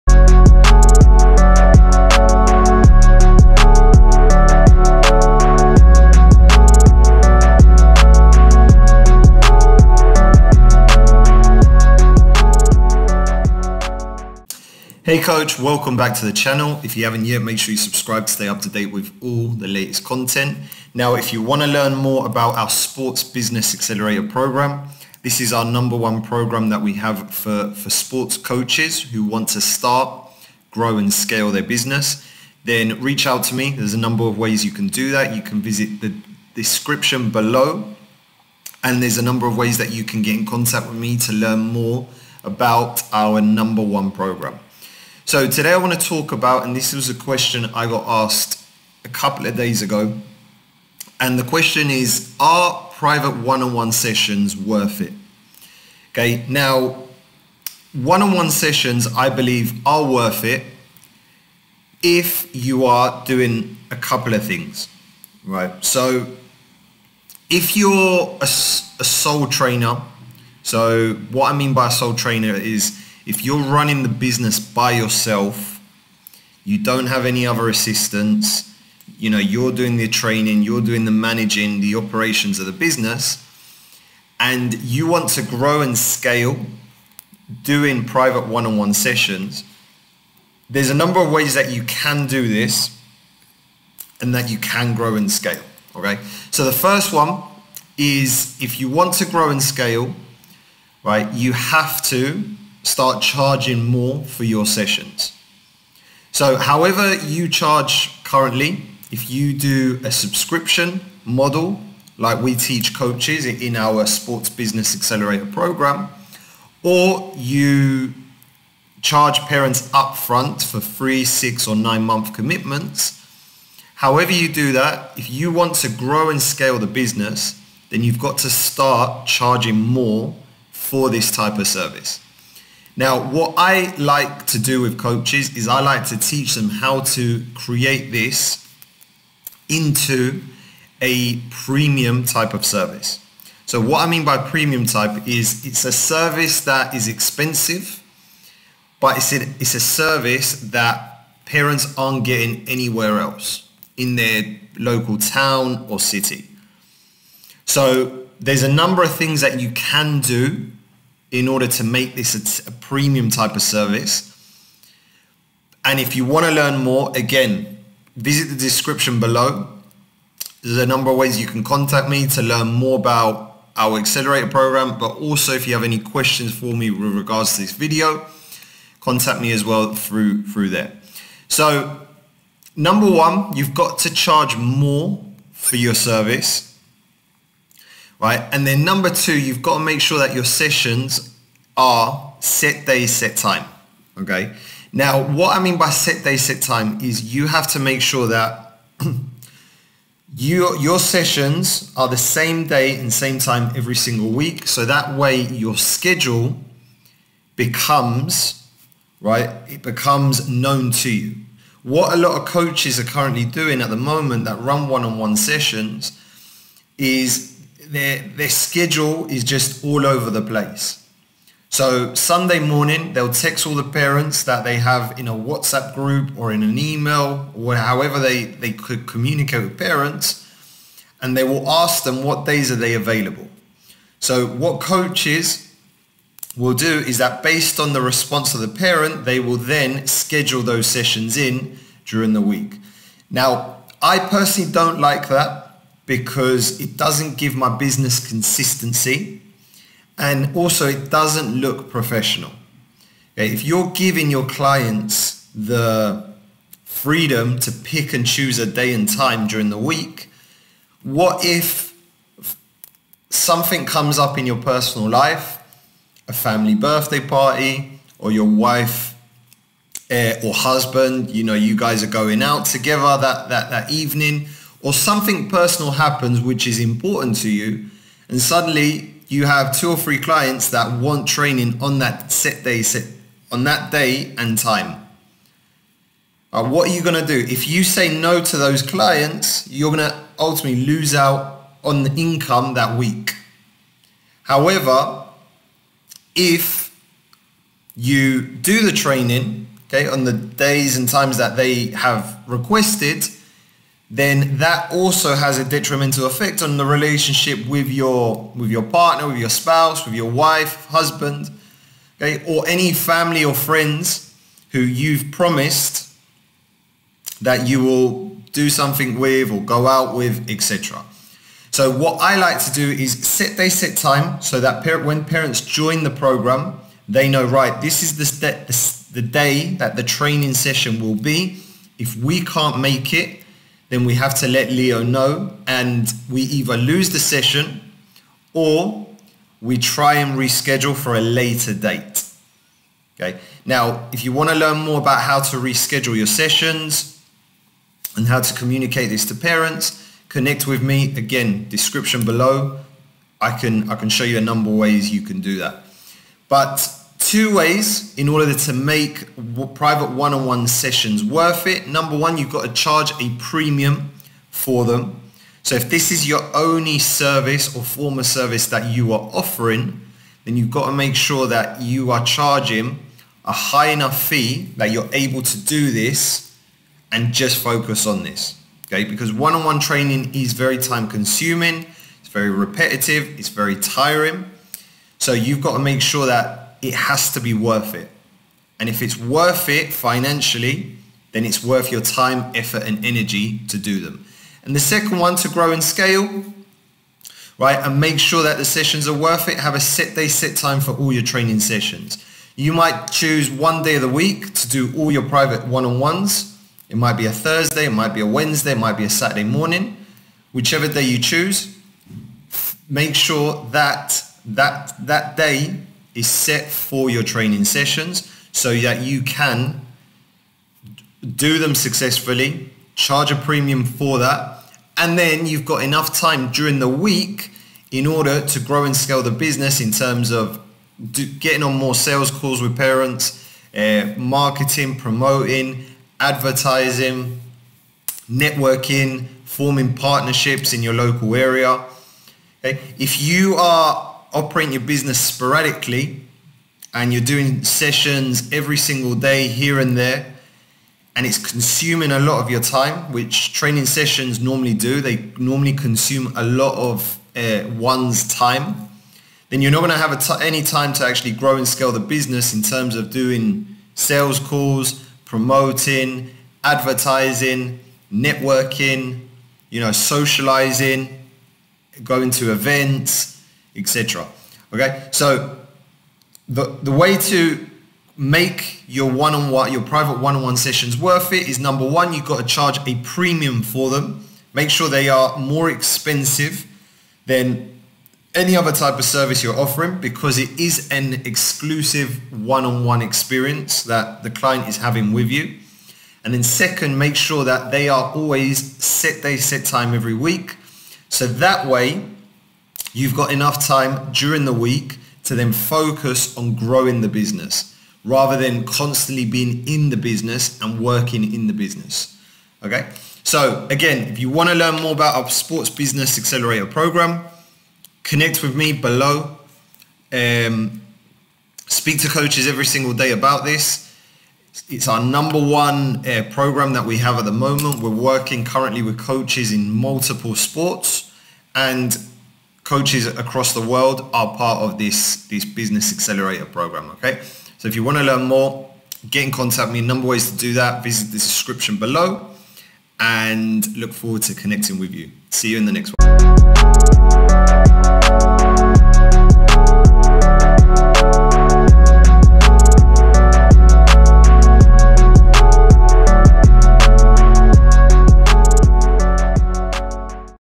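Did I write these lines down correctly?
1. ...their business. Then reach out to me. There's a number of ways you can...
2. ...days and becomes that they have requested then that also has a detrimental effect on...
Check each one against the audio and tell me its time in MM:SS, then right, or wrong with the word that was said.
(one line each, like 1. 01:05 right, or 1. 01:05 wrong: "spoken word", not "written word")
1. 00:31 right
2. 05:00 wrong: "times", not "becomes".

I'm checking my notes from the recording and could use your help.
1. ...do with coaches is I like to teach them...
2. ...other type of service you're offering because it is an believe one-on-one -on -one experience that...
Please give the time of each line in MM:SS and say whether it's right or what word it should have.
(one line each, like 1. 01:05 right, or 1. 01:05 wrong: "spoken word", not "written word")
1. 02:14 right
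2. 08:08 wrong: "exclusive", not "believe".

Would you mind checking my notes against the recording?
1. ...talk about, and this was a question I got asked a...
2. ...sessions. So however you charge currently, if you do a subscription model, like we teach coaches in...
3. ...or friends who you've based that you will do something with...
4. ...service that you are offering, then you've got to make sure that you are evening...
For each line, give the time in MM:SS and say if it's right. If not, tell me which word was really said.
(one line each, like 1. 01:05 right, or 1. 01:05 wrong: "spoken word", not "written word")
1. 00:46 right
2. 01:44 right
3. 05:13 wrong: "promised", not "based"
4. 06:08 wrong: "charging", not "evening".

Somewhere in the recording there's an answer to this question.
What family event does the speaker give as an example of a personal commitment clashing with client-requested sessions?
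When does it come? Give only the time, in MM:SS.
04:26.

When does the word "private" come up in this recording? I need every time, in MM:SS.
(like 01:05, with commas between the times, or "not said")
00:52, 01:28, 05:59, 06:45, 07:59.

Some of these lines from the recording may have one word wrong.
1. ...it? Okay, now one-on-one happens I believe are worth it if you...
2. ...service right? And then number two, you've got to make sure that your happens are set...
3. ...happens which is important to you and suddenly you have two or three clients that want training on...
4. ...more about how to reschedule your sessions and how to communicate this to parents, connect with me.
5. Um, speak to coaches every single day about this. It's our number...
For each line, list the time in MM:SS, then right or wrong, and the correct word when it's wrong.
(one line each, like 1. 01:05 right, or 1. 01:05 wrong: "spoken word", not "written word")
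1. 00:54 wrong: "sessions", not "happens"
2. 03:05 wrong: "sessions", not "happens"
3. 04:35 right
4. 05:44 right
5. 08:40 right.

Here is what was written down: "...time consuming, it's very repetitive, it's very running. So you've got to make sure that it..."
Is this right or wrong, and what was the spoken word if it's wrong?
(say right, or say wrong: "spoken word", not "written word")
wrong: "tiring", not "running".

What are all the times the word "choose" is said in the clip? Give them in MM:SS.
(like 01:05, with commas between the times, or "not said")
04:18, 06:43, 06:51.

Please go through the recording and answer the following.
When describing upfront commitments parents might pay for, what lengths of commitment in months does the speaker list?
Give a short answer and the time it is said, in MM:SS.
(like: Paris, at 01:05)
3, 6 or 9 months, at 02:00.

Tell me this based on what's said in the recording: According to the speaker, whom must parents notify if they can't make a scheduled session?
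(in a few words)
Leo.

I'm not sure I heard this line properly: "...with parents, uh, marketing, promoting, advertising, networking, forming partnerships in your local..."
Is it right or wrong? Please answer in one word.
right.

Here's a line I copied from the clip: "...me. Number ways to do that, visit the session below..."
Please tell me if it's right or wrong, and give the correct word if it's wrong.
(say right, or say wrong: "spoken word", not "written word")
wrong: "description", not "session".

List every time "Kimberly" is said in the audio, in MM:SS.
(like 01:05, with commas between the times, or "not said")
not said.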